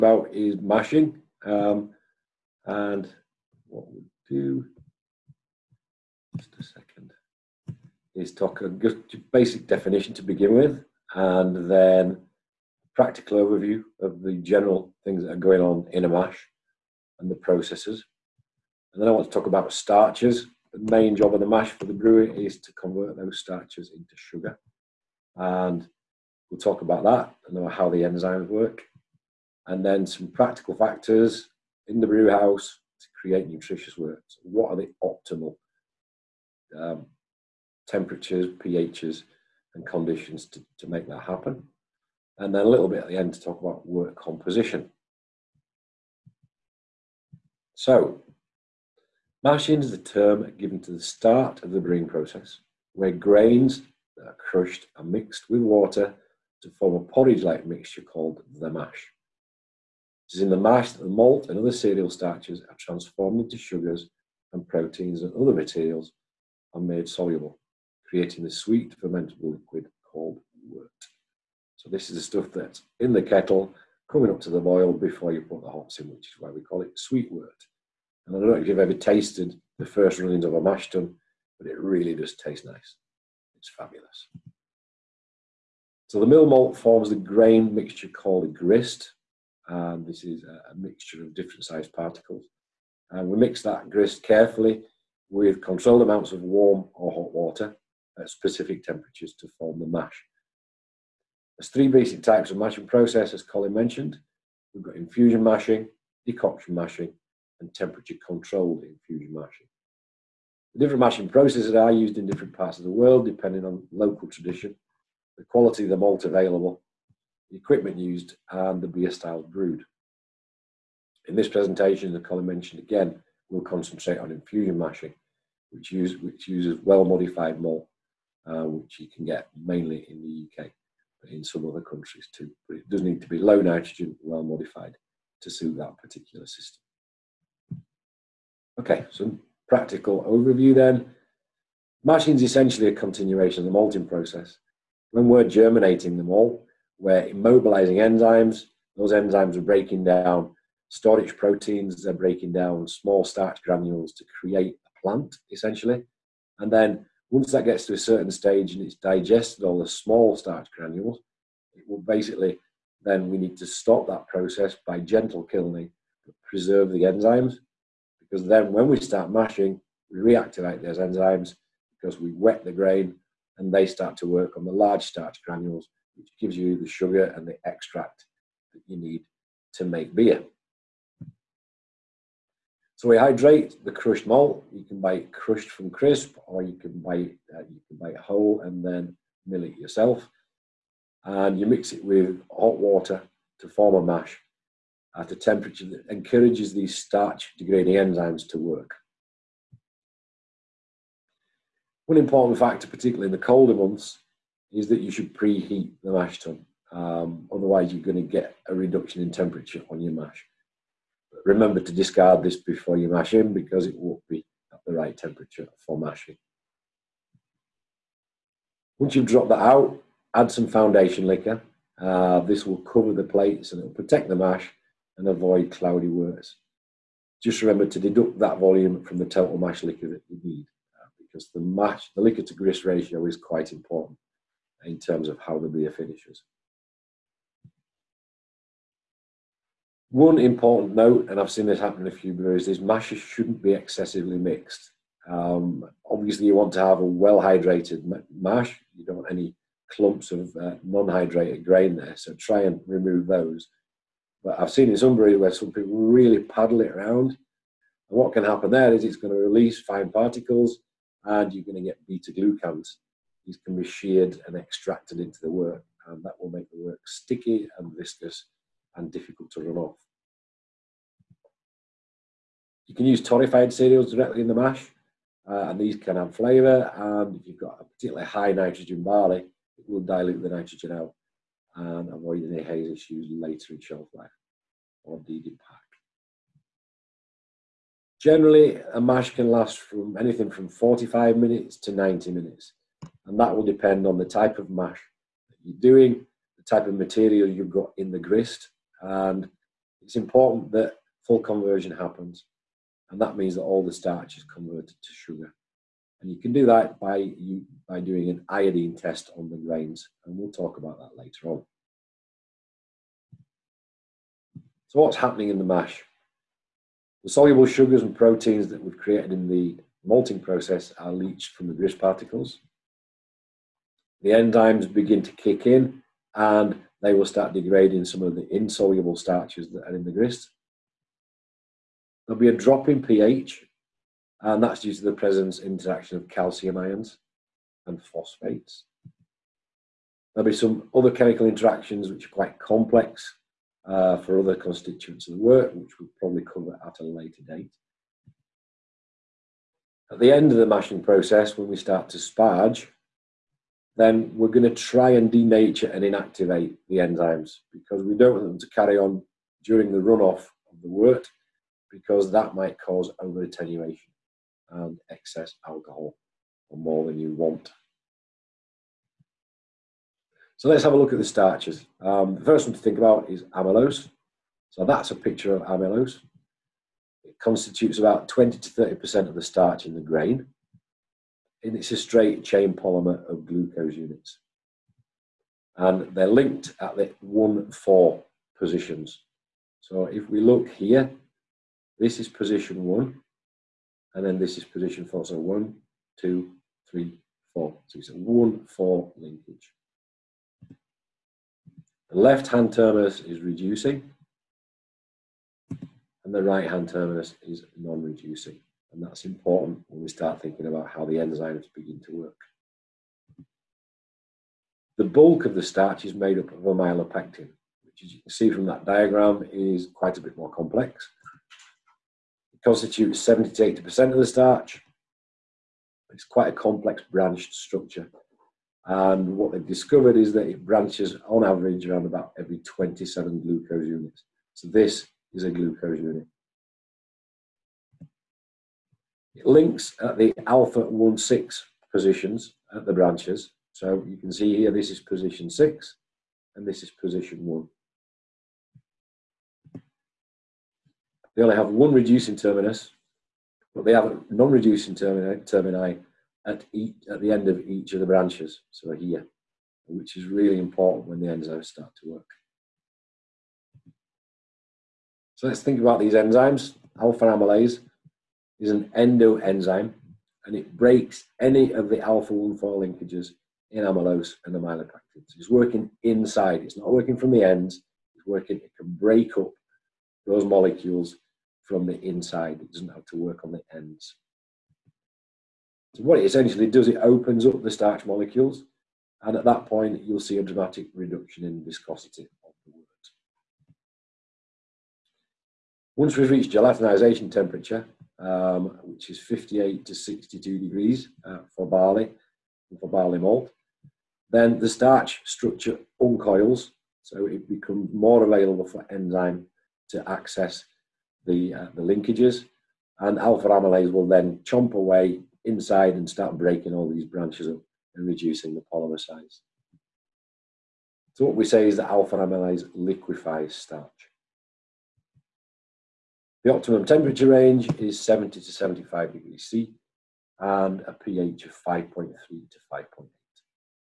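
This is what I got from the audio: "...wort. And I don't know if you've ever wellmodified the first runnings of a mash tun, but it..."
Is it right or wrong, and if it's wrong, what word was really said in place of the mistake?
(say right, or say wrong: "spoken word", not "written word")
wrong: "tasted", not "wellmodified".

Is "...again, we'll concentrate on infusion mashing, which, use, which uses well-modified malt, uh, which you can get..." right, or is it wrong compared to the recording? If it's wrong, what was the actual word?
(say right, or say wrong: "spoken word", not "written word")
right.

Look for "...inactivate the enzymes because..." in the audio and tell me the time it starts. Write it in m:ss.
5:56.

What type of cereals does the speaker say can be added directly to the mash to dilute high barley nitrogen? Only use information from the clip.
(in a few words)
torrefied cereals.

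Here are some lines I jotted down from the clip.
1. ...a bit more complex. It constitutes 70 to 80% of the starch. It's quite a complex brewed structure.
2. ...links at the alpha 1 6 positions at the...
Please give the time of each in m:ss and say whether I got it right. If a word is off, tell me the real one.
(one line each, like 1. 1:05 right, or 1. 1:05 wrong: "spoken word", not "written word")
1. 7:00 wrong: "branched", not "brewed"
2. 7:19 right.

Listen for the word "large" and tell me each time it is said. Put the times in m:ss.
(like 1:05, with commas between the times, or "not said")
2:54.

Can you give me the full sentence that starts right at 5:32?
There'll be a drop in pH, and that's due to the presence interaction of calcium ions and phosphates.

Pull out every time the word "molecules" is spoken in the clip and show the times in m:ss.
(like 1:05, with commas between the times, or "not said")
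8:00, 8:08.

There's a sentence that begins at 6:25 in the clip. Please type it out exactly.
And they're linked at the 1, 4 positions.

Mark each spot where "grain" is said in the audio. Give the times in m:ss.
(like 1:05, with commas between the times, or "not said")
0:53, 1:27, 2:52, 4:11, 5:09, 6:19.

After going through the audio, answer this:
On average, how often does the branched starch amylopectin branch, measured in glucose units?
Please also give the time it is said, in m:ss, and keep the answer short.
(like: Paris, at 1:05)
every 27 glucose units, at 7:12.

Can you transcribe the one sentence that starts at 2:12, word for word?
But it does need to be low nitrogen, well-modified to suit that particular system.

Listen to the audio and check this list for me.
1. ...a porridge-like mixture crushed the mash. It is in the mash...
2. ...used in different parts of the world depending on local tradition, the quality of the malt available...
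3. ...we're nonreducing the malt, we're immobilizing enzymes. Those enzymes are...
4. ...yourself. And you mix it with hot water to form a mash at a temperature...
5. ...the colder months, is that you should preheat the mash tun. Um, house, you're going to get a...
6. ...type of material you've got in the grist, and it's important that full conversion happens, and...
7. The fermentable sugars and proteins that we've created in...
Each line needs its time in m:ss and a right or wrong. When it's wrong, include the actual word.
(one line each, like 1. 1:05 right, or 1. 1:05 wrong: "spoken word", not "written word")
1. 0:56 wrong: "called", not "crushed"
2. 1:51 right
3. 2:25 wrong: "germinating", not "nonreducing"
4. 3:09 right
5. 3:23 wrong: "otherwise", not "house"
6. 4:56 right
7. 5:17 wrong: "soluble", not "fermentable".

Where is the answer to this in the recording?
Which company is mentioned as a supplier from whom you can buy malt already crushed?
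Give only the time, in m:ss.
3:05.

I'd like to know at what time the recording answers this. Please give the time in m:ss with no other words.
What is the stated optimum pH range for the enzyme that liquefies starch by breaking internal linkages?
8:51.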